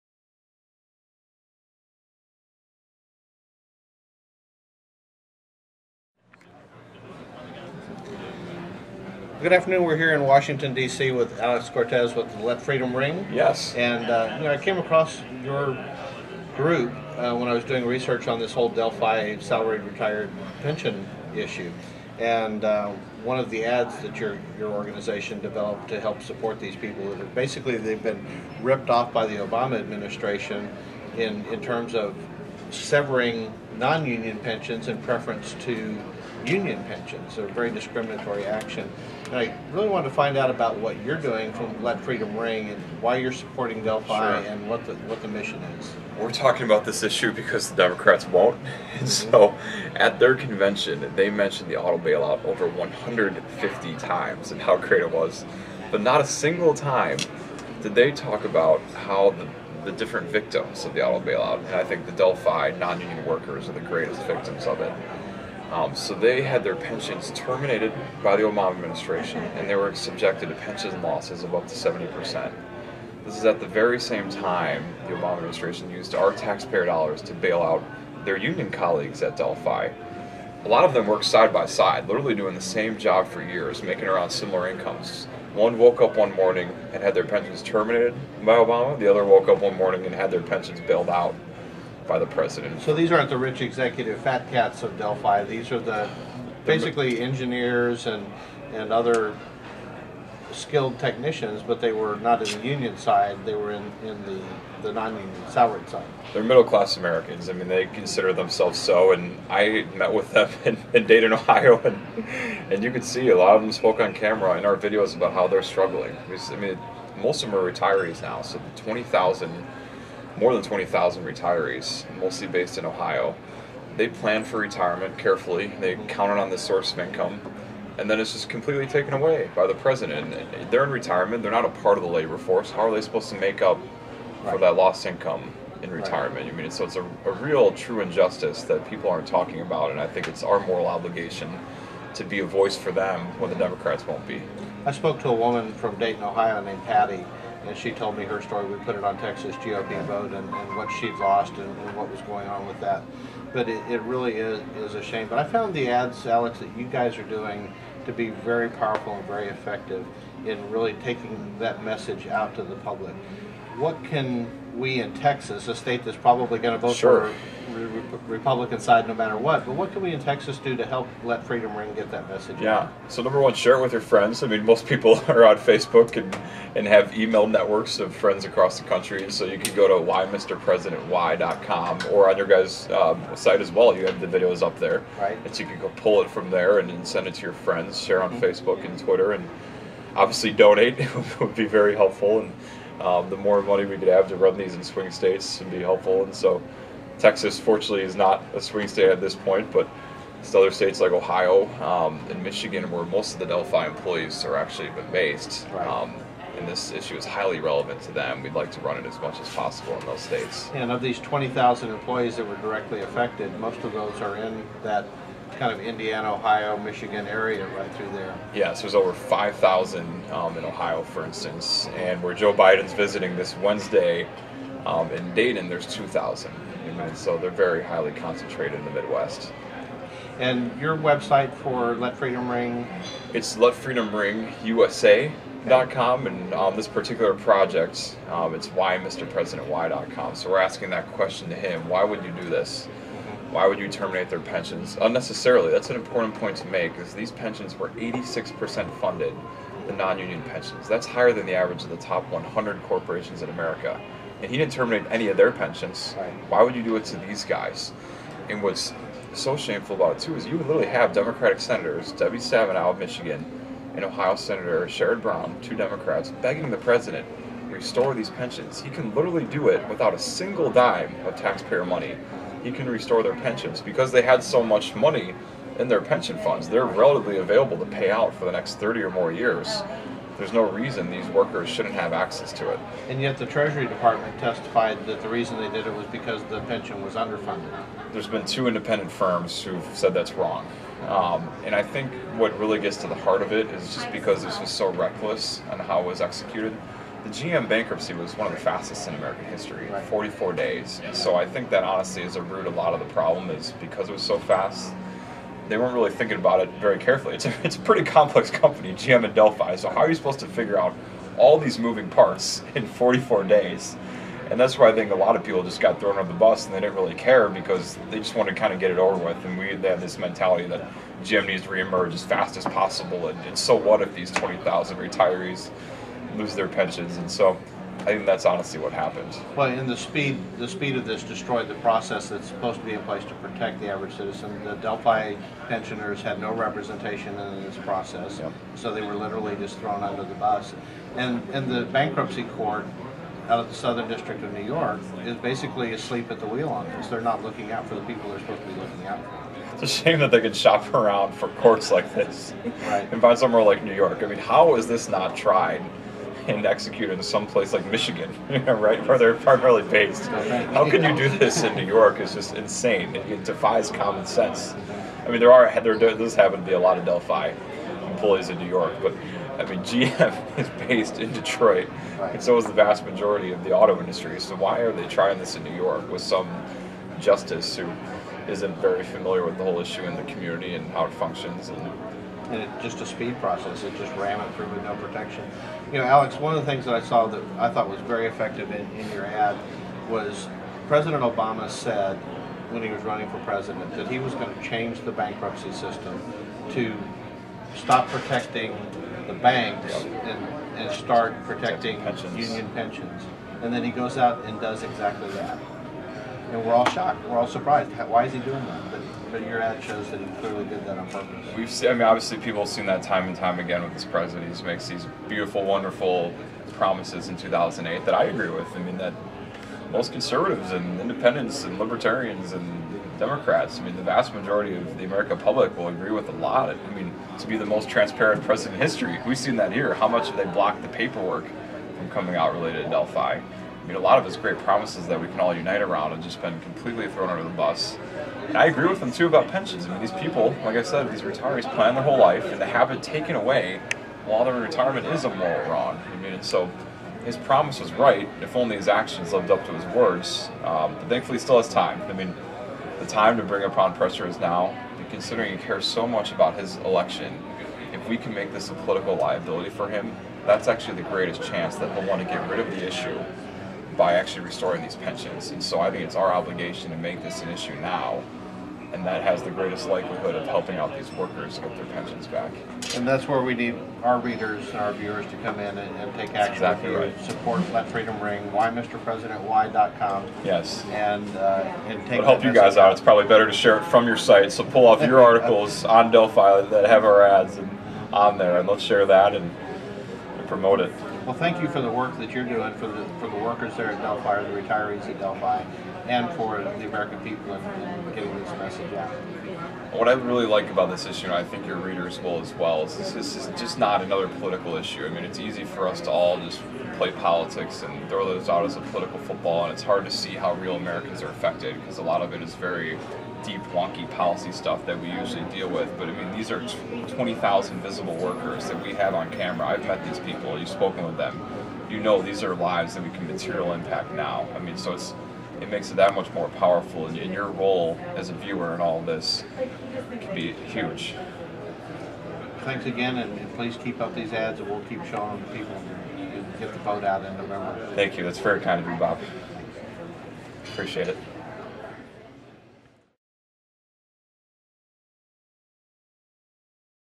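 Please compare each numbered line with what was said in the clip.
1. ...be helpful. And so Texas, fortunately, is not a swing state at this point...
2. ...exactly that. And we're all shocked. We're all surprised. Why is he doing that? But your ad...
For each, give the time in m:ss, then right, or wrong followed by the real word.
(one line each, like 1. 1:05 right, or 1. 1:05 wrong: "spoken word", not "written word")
1. 3:15 right
2. 6:44 right.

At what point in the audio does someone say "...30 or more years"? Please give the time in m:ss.
4:38.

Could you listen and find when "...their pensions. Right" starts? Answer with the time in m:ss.
4:15.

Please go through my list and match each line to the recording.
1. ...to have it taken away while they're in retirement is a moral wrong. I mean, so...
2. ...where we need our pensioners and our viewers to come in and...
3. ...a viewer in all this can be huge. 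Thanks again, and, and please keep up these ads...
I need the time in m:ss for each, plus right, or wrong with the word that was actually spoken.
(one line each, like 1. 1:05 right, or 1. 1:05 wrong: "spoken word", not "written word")
1. 7:22 right
2. 7:53 wrong: "readers", not "pensioners"
3. 8:48 right.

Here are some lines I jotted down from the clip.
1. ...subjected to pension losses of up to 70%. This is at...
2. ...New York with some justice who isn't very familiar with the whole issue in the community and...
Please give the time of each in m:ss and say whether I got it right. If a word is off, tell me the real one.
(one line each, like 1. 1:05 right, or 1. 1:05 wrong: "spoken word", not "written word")
1. 1:09 right
2. 6:15 right.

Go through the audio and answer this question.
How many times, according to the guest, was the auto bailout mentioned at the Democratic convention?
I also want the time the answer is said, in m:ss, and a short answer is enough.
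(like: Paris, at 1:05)
over 150, at 0:52.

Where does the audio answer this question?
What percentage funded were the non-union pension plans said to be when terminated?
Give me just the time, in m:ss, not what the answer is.
4:07.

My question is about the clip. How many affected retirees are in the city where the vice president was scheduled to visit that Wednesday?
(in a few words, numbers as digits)
2,000.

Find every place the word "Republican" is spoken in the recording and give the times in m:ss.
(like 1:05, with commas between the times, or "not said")
2:48.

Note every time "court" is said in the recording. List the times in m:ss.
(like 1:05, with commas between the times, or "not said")
5:42, 5:51.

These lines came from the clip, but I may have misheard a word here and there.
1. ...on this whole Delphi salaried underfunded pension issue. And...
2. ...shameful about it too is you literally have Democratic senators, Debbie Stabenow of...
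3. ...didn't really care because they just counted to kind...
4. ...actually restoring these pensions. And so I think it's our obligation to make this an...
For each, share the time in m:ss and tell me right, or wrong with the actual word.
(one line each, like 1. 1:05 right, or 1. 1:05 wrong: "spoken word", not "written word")
1. 0:18 wrong: "retired", not "underfunded"
2. 4:19 right
3. 5:16 wrong: "wanted", not "counted"
4. 7:44 right.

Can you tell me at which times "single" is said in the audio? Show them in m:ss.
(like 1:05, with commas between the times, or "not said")
0:56, 4:30.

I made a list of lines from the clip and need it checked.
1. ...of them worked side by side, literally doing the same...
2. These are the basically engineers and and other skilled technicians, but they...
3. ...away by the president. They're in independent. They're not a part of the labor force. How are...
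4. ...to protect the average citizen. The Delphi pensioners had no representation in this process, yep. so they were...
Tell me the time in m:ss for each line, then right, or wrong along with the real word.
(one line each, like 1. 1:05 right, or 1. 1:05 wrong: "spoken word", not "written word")
1. 1:20 right
2. 1:35 right
3. 2:09 wrong: "retirement", not "independent"
4. 5:33 right.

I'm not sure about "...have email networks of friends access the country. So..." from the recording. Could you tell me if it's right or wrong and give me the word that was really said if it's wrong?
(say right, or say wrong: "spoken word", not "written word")
wrong: "across", not "access".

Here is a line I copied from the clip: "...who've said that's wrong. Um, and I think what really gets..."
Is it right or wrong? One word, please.
right.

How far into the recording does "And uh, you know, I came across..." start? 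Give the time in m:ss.
0:13.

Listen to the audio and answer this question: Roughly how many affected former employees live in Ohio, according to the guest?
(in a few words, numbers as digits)
over 5,000.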